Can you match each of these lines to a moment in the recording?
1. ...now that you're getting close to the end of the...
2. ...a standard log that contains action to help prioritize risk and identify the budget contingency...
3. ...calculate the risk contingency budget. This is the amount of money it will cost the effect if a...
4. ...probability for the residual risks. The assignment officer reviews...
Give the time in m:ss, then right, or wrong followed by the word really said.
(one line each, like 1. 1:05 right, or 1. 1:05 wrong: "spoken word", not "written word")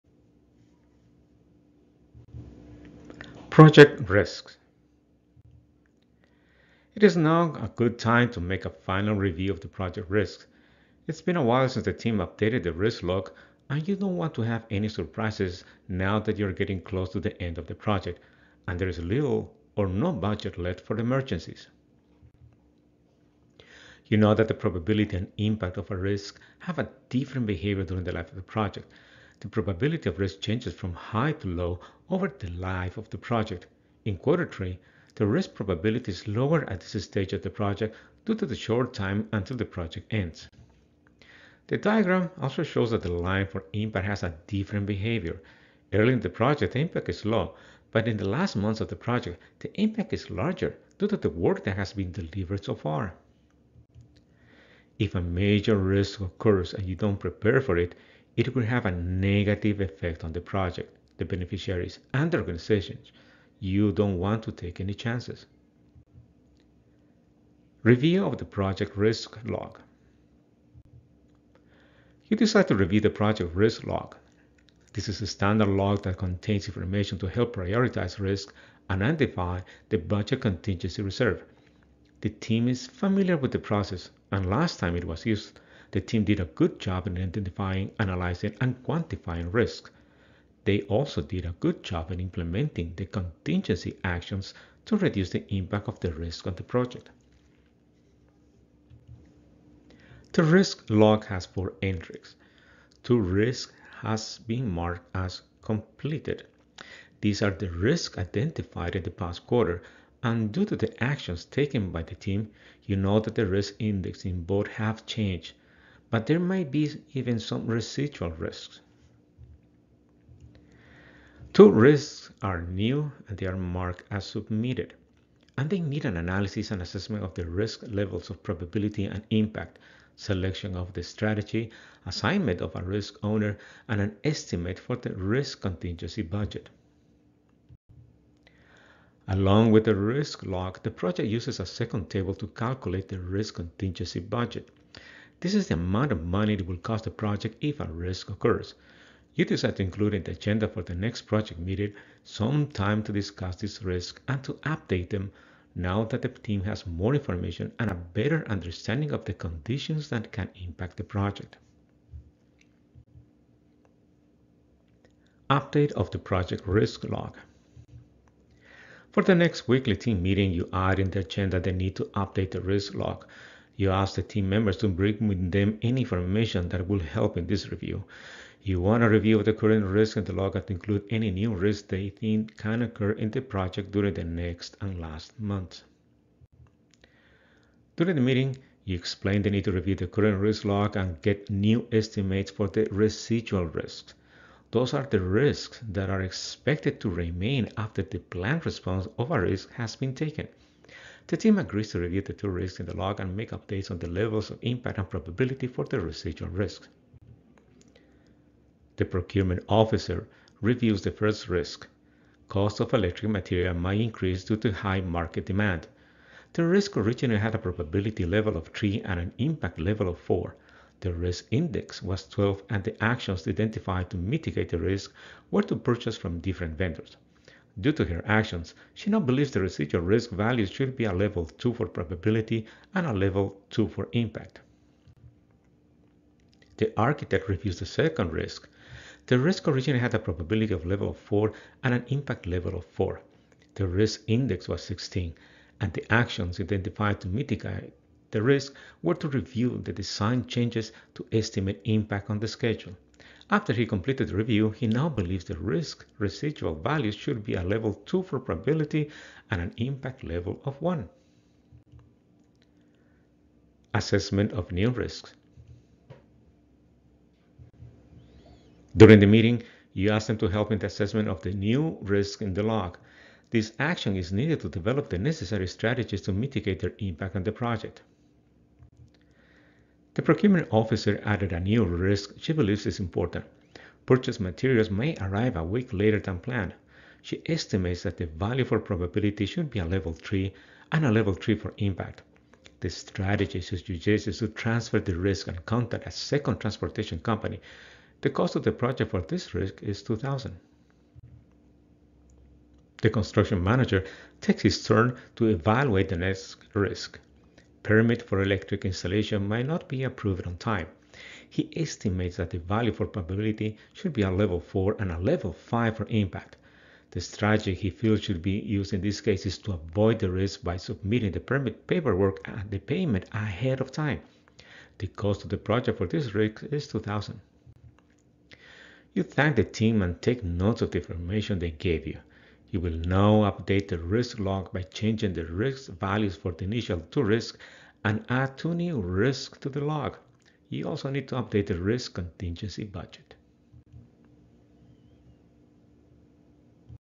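1. 0:15 right
2. 1:15 wrong: "information", not "action"
3. 2:22 wrong: "project", not "effect"
4. 3:25 wrong: "procurement", not "assignment".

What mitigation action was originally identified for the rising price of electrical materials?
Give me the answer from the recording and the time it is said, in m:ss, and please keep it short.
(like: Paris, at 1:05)
Purchase from different vendors, at 3:45.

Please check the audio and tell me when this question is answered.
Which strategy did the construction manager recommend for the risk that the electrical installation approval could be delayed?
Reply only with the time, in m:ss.
5:19.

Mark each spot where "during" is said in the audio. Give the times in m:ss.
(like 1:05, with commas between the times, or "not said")
0:27, 3:03, 3:07, 4:28.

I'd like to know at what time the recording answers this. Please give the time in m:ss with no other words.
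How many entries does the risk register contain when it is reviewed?
1:41.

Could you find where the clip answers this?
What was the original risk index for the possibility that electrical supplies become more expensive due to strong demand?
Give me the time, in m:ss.
3:42.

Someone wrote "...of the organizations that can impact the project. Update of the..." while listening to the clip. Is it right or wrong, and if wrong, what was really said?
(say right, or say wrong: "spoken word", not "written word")
wrong: "conditions", not "organizations".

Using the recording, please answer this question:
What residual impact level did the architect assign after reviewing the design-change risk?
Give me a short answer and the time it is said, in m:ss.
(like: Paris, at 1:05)
1, at 4:20.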